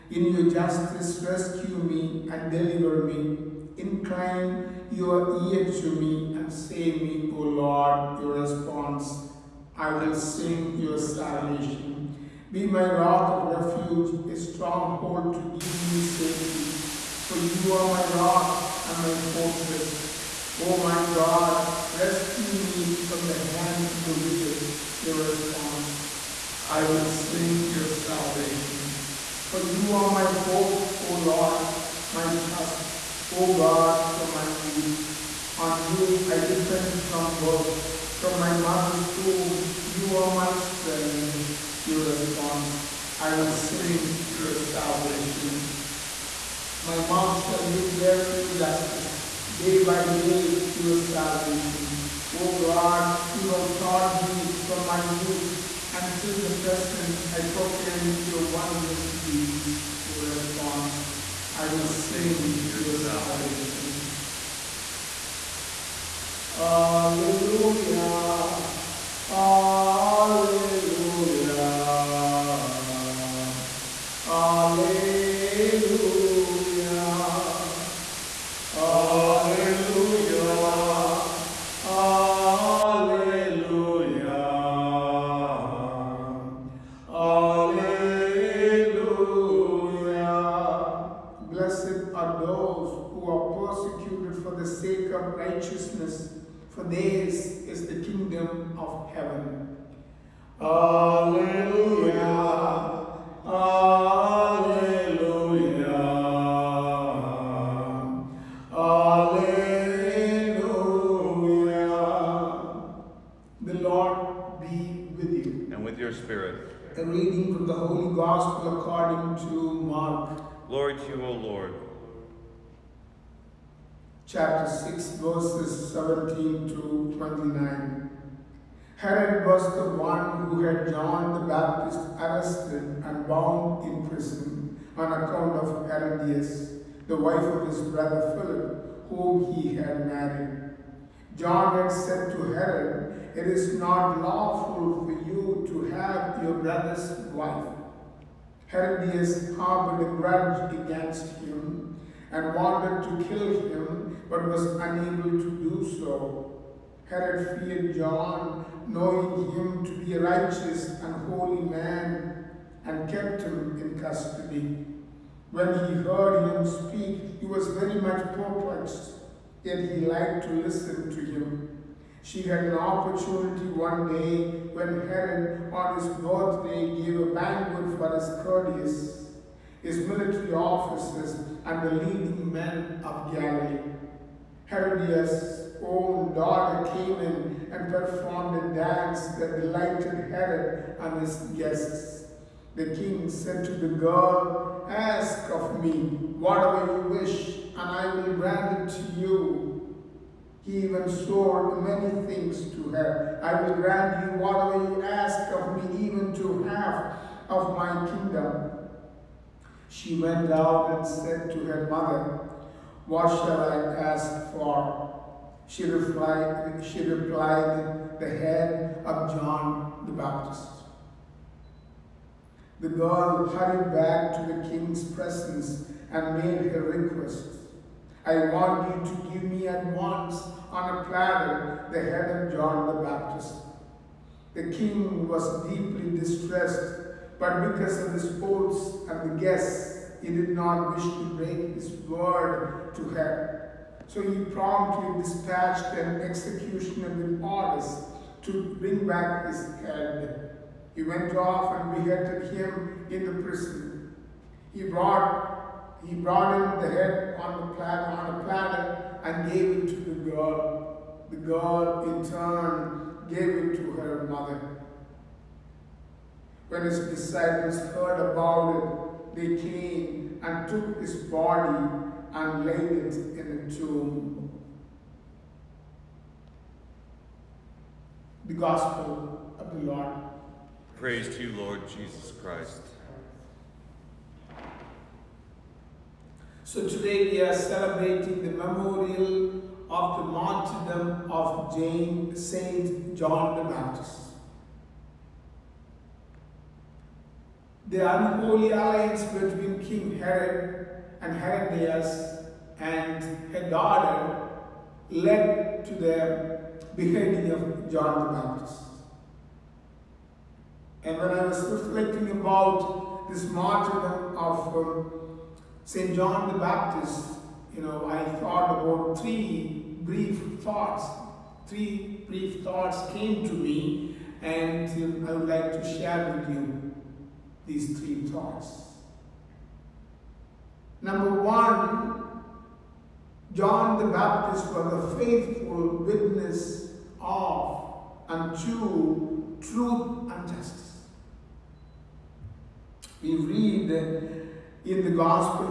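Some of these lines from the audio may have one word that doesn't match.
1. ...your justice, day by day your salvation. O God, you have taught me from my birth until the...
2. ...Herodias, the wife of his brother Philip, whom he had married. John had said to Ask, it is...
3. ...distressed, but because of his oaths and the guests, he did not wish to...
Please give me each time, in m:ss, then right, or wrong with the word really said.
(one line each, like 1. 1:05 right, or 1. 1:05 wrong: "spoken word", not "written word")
1. 0:48 wrong: "youth", not "birth"
2. 2:15 wrong: "Herod", not "Ask"
3. 3:56 right.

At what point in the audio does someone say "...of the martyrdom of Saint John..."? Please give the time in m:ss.
4:49.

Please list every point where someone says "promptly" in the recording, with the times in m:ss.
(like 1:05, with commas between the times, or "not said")
4:04.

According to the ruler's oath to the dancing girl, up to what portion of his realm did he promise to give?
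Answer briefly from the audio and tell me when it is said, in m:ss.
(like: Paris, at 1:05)
Half of my kingdom, at 3:26.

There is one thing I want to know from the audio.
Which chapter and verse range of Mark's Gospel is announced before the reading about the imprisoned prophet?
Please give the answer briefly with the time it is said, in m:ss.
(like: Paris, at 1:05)
Chapter 6, verses 17 to 29, at 2:04.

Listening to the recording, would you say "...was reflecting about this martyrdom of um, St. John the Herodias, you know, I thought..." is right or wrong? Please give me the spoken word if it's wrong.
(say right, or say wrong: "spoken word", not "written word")
wrong: "Baptist", not "Herodias".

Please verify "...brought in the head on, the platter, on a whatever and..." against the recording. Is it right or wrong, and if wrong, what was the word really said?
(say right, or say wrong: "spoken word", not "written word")
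wrong: "platter", not "whatever".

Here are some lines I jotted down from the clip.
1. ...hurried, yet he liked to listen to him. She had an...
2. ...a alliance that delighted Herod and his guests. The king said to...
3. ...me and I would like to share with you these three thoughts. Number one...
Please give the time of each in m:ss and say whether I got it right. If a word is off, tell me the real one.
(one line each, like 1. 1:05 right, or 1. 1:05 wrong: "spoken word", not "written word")
1. 2:48 wrong: "perplexed", not "hurried"
2. 3:08 wrong: "dance", not "alliance"
3. 5:23 right.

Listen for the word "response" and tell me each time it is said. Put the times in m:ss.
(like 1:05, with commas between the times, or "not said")
0:08, 0:25, 0:42, 1:00.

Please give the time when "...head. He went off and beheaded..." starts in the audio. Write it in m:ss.
4:09.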